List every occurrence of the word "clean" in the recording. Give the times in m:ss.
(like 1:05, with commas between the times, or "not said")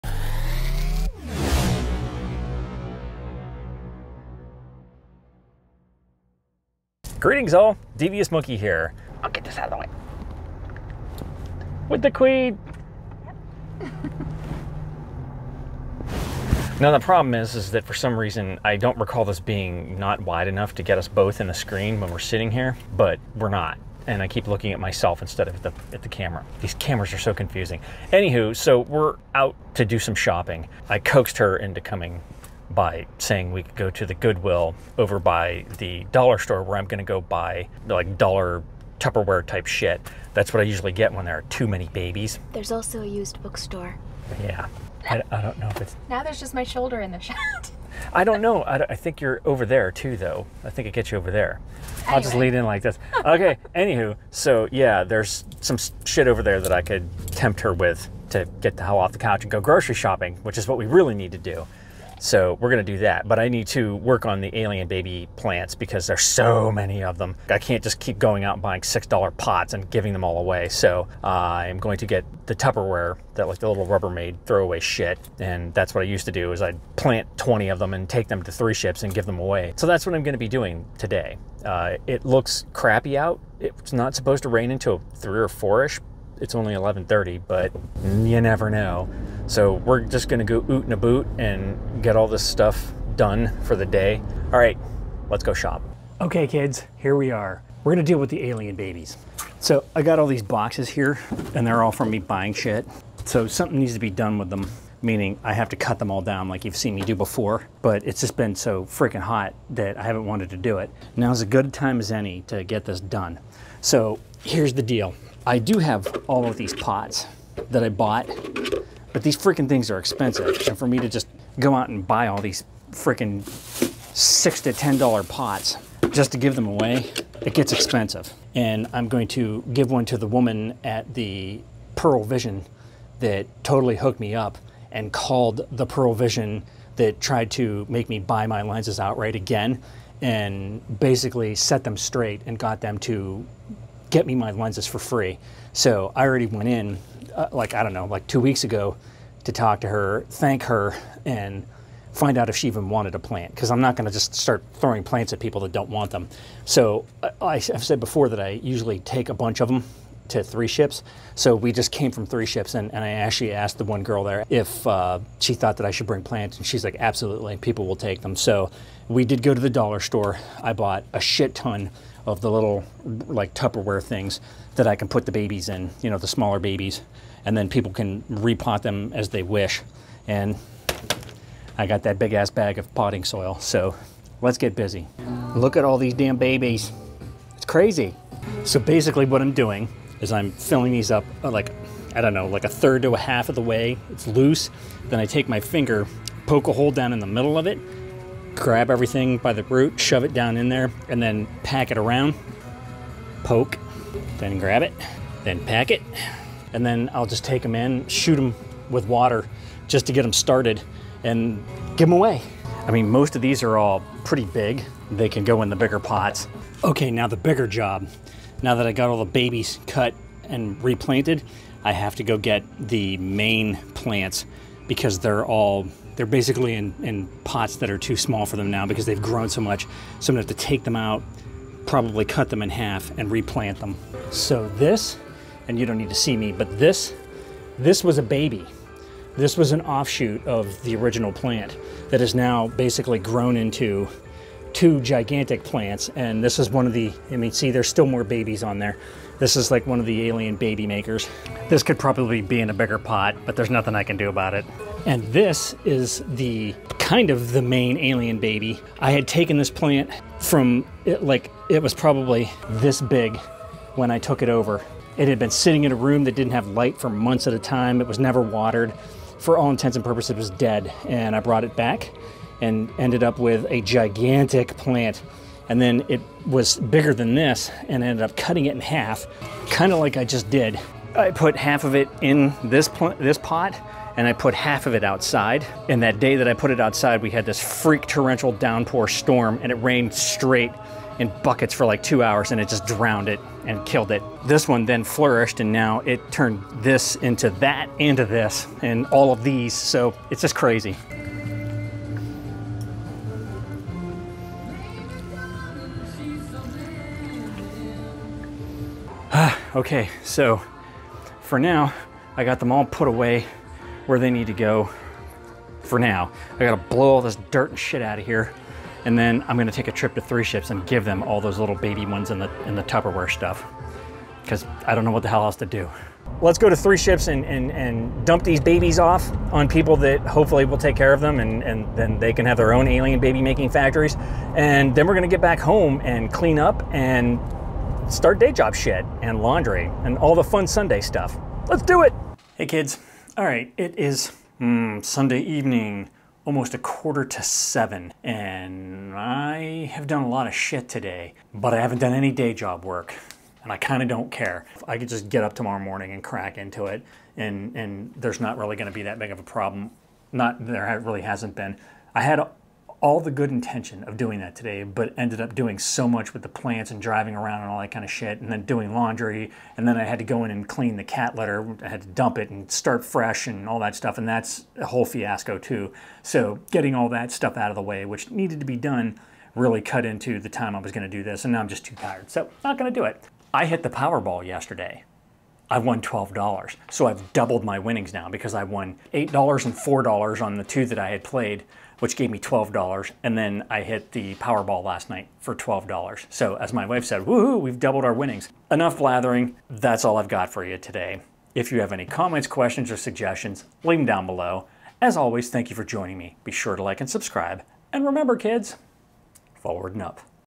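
5:36, 6:10.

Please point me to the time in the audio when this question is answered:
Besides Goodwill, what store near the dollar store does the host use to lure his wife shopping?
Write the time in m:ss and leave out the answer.
0:43.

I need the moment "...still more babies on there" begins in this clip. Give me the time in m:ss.
4:07.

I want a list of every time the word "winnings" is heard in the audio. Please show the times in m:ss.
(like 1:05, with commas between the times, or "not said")
6:27, 6:38.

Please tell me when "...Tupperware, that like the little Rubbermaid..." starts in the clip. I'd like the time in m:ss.
1:12.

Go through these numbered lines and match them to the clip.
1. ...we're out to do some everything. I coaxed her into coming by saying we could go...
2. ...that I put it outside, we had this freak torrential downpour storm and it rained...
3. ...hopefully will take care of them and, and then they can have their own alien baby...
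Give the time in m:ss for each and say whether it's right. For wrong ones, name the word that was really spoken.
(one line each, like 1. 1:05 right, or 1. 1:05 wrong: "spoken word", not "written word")
1. 0:28 wrong: "shopping", not "everything"
2. 4:46 right
3. 5:30 right.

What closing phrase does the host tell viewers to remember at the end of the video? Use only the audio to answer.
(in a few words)
Forward and up.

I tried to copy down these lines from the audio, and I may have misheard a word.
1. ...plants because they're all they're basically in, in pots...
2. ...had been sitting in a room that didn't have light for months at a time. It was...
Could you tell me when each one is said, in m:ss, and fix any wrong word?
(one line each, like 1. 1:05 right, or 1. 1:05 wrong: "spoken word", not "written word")
1. 3:43 right
2. 4:25 right.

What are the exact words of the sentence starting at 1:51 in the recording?
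Now's as good a time as any to get this done.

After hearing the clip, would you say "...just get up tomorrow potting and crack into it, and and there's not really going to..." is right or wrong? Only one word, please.
wrong.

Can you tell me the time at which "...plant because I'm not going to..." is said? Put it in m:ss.
2:33.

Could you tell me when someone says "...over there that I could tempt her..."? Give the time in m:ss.
0:56.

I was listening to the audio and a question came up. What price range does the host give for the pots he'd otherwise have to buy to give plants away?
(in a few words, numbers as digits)
$6 to $10.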